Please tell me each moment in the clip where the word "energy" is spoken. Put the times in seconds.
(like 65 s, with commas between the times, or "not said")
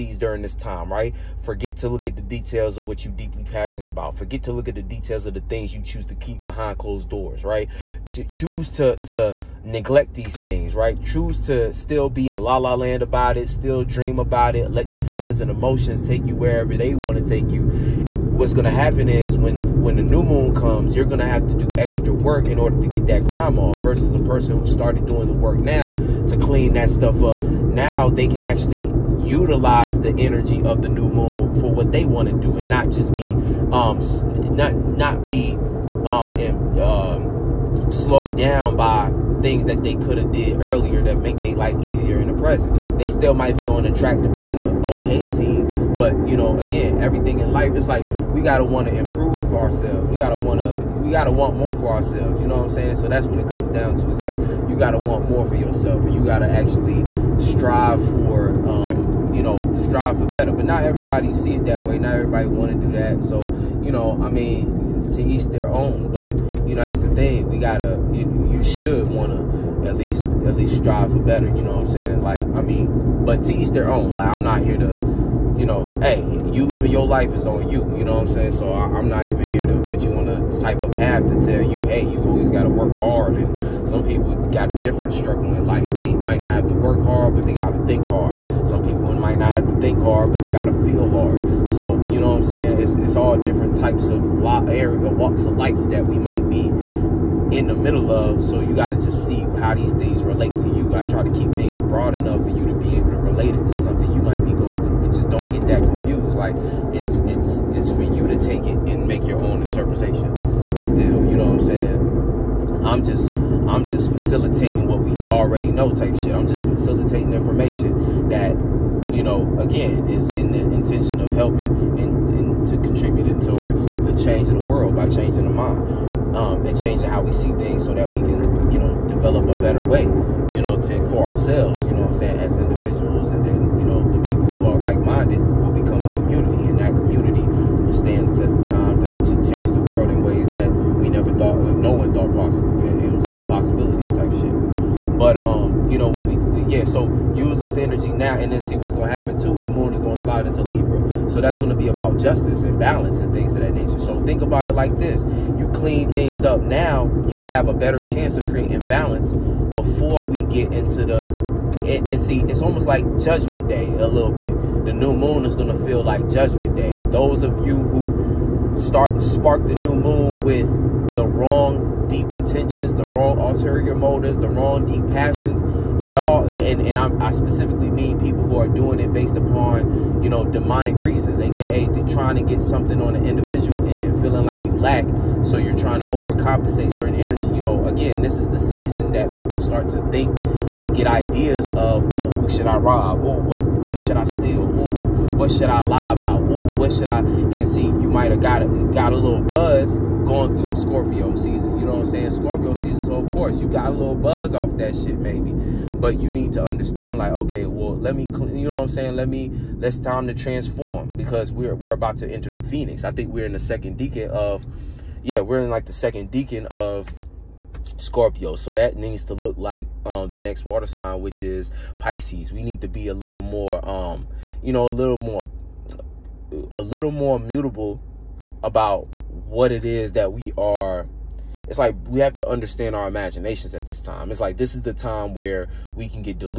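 30 s, 147 s, 187 s.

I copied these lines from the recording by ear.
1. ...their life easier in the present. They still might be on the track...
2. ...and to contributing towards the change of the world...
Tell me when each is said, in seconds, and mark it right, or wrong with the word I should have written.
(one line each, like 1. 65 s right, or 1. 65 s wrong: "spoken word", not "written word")
1. 41 s right
2. 122 s right.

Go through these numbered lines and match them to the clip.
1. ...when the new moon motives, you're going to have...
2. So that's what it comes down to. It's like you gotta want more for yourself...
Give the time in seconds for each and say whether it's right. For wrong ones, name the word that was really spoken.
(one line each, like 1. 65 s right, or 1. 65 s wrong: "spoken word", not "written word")
1. 19 s wrong: "comes", not "motives"
2. 52 s right.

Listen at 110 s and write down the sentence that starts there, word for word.
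Still, you know what I'm saying?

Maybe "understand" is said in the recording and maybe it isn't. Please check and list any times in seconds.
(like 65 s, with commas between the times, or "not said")
206 s, 232 s.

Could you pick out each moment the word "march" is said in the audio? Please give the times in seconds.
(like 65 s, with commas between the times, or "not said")
not said.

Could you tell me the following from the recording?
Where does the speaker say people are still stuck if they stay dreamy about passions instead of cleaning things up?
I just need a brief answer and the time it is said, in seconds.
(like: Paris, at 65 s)
la la land, at 12 s.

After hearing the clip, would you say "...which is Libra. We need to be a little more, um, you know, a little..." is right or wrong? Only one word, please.
wrong.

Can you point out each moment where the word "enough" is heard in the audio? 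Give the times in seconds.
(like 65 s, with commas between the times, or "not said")
102 s.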